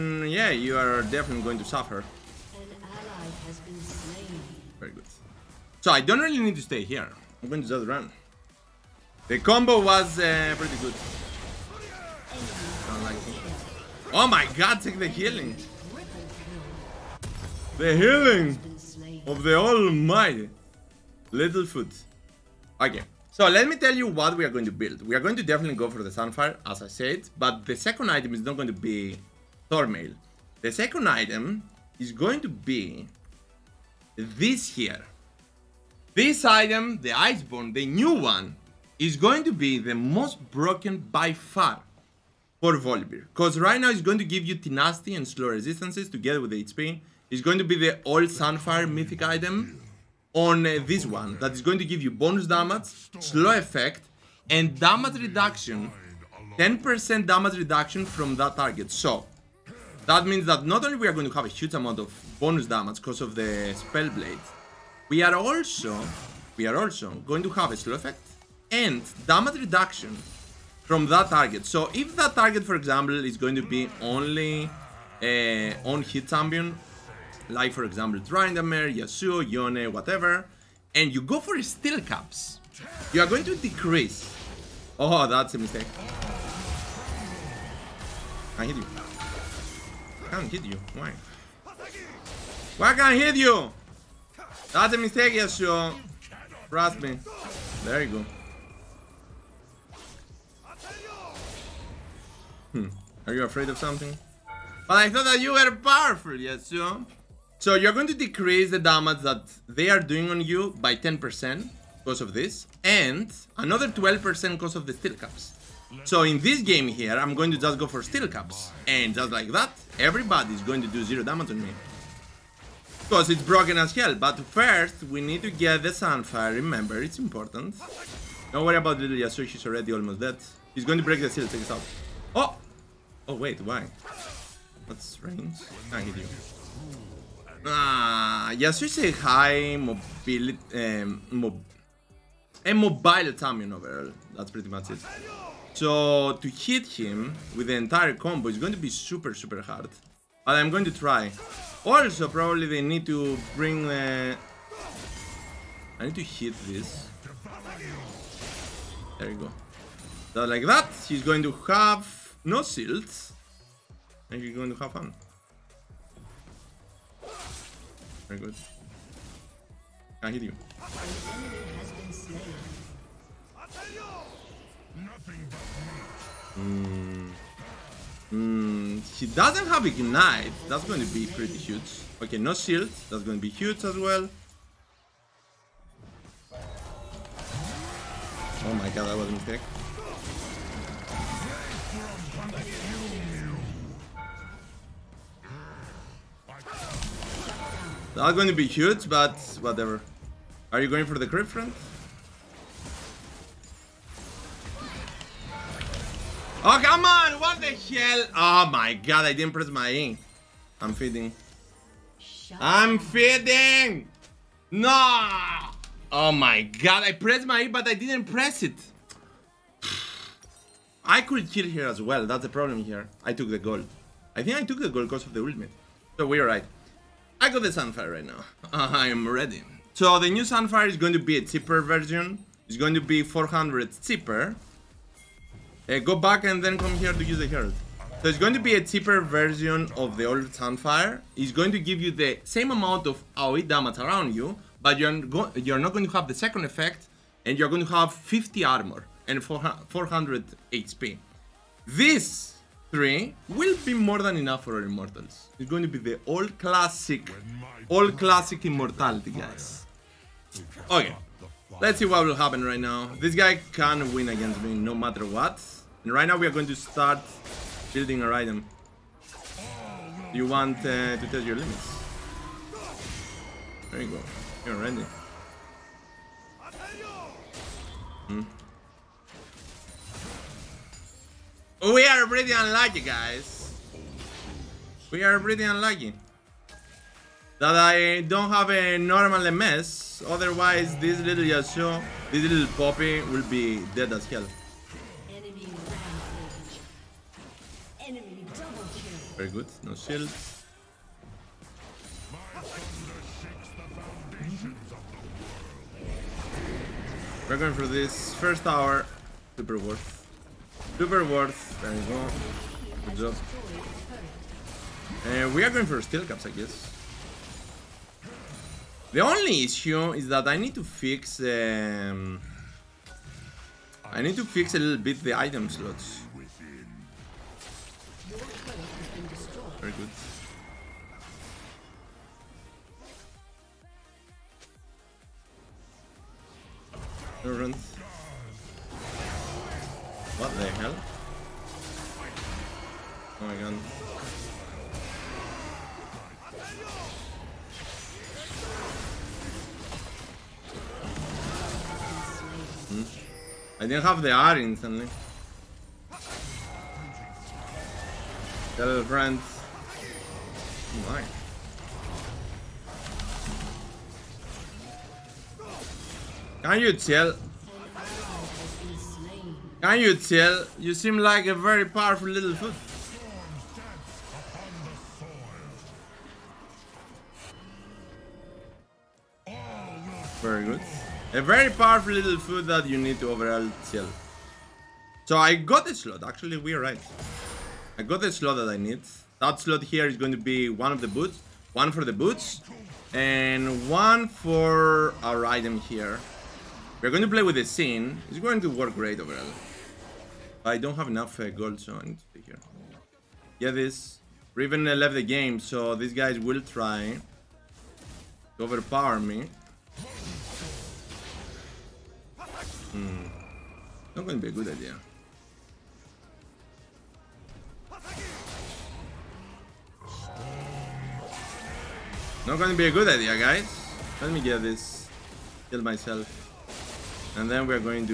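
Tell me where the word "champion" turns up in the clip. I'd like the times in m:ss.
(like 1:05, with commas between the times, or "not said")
1:16, 2:23.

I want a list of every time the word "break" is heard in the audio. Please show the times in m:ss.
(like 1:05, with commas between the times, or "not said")
2:11.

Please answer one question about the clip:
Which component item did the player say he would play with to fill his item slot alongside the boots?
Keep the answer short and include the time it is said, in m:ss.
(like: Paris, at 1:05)
Sheen, at 6:37.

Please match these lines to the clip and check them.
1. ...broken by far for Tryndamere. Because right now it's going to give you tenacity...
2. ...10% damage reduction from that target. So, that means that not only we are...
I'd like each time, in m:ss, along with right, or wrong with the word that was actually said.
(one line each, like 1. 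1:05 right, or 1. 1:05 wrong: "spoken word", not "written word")
1. 0:40 wrong: "Volibear", not "Tryndamere"
2. 0:56 right.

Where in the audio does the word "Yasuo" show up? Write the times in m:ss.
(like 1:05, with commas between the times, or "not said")
1:18, 1:35, 1:46, 2:09, 4:51.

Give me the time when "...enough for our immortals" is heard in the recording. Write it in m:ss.
4:14.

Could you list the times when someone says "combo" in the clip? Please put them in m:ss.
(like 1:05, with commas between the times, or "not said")
0:09, 2:28.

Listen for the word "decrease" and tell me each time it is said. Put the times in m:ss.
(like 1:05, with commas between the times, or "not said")
1:23, 1:48.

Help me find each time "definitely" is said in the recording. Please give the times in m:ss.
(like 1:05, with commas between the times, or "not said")
0:01, 0:25.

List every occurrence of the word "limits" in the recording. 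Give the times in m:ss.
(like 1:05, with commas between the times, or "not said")
4:31.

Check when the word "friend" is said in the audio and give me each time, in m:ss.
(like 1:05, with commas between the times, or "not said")
3:21, 5:59.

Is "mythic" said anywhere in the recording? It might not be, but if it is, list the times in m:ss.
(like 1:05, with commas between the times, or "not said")
0:48.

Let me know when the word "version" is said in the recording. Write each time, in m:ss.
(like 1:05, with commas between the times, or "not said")
3:51, 3:59.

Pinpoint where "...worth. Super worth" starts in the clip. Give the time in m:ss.
5:09.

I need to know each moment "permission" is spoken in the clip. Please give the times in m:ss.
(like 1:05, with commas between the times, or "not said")
not said.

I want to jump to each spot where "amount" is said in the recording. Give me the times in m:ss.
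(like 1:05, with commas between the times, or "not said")
1:01, 4:02.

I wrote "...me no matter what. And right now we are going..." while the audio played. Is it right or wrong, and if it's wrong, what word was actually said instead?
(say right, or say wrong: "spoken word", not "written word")
right.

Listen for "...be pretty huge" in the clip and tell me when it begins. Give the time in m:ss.
3:01.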